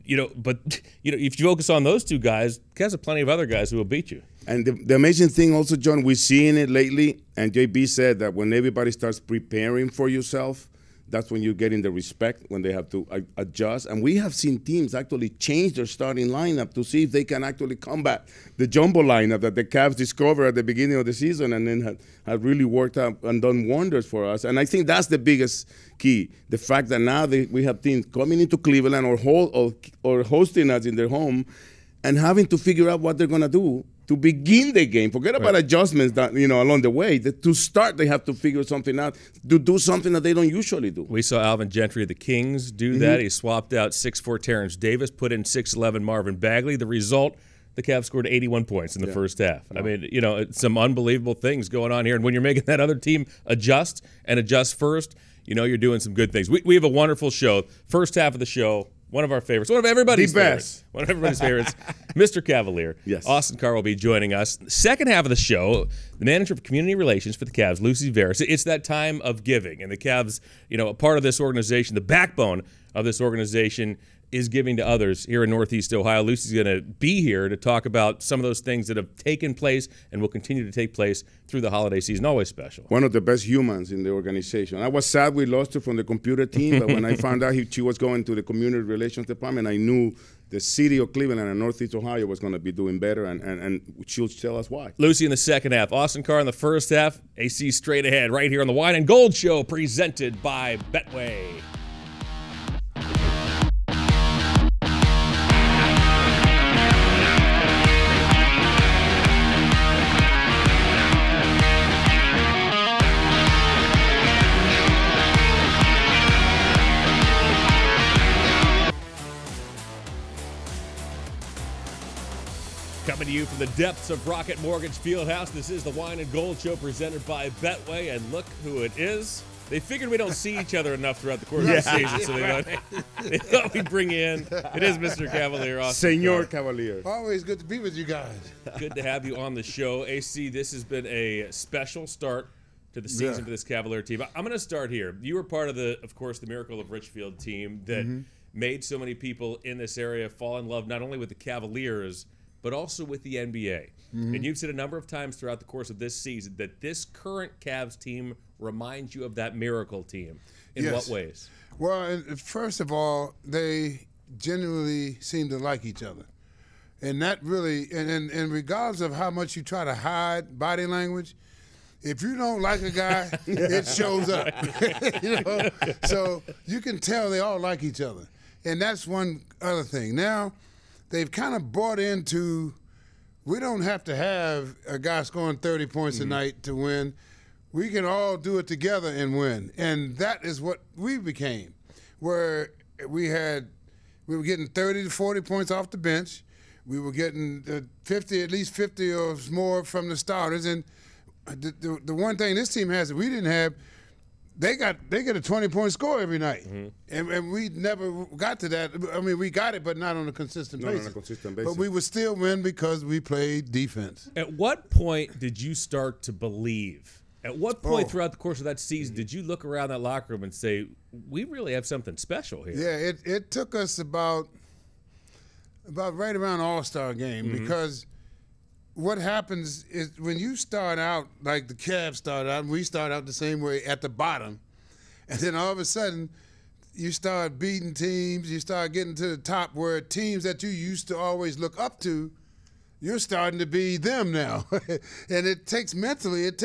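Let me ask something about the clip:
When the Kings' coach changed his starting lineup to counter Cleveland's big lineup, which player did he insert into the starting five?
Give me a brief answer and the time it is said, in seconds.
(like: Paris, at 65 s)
Marvin Bagley, at 46 s.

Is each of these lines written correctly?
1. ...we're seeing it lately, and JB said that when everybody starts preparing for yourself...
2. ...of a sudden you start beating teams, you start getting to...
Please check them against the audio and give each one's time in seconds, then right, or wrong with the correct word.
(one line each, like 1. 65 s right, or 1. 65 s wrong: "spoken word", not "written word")
1. 6 s right
2. 235 s right.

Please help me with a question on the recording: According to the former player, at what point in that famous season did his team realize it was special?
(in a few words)
All Star game.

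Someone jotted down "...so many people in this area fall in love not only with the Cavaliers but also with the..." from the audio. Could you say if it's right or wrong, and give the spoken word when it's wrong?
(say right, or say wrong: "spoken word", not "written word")
right.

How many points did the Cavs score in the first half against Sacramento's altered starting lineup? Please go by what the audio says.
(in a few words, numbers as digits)
81.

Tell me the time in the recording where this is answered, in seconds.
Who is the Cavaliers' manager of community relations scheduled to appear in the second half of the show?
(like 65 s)
67 s.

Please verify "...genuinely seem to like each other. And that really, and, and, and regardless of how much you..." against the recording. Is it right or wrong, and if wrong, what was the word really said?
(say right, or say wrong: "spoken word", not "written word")
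right.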